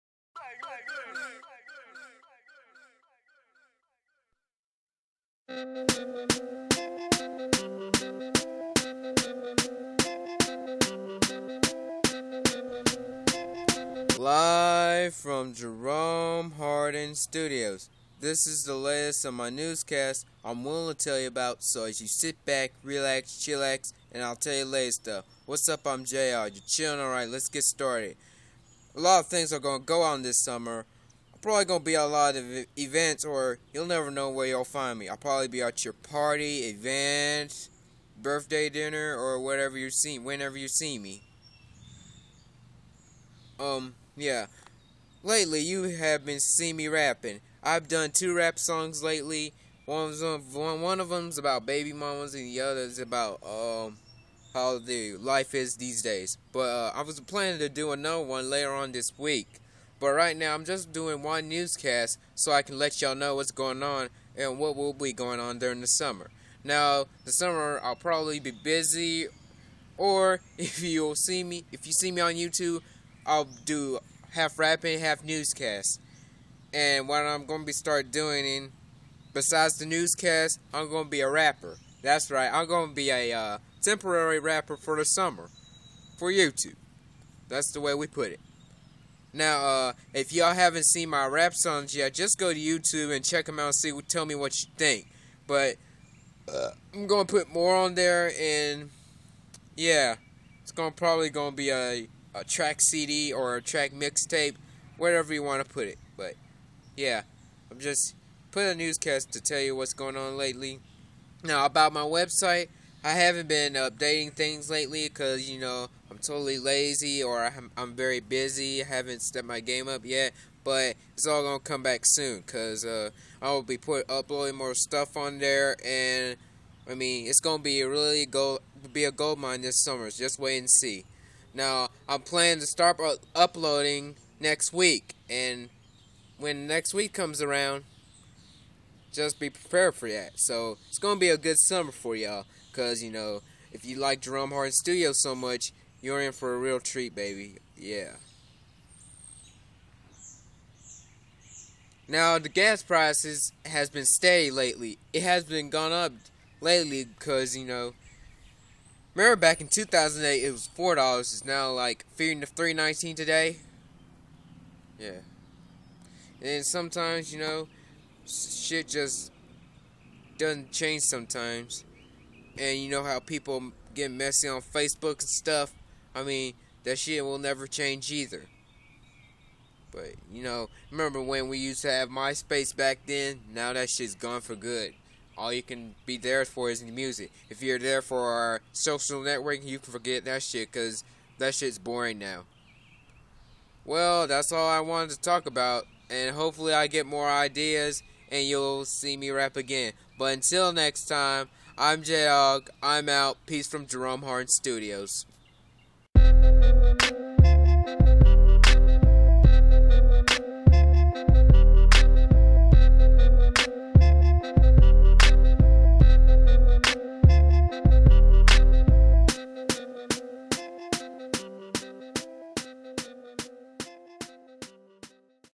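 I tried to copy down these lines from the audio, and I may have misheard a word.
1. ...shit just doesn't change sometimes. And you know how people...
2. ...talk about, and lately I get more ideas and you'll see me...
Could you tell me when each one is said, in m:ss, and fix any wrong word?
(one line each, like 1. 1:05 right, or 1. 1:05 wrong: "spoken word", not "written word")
1. 2:48 right
2. 3:15 wrong: "hopefully", not "lately".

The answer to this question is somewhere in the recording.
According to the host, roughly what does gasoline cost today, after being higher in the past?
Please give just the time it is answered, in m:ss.
2:42.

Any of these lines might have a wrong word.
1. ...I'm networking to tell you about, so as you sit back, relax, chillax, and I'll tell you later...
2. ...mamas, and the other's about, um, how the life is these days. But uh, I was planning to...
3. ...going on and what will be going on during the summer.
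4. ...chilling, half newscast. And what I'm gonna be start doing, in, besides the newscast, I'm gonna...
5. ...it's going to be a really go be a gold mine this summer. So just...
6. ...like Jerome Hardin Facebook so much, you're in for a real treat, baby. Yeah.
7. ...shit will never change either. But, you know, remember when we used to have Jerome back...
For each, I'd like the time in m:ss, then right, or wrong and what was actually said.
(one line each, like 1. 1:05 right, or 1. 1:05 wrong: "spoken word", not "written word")
1. 0:20 wrong: "willing", not "networking"
2. 0:51 right
3. 1:03 right
4. 1:14 wrong: "rapping", not "chilling"
5. 2:07 right
6. 2:23 wrong: "Studio", not "Facebook"
7. 2:56 wrong: "MySpace", not "Jerome".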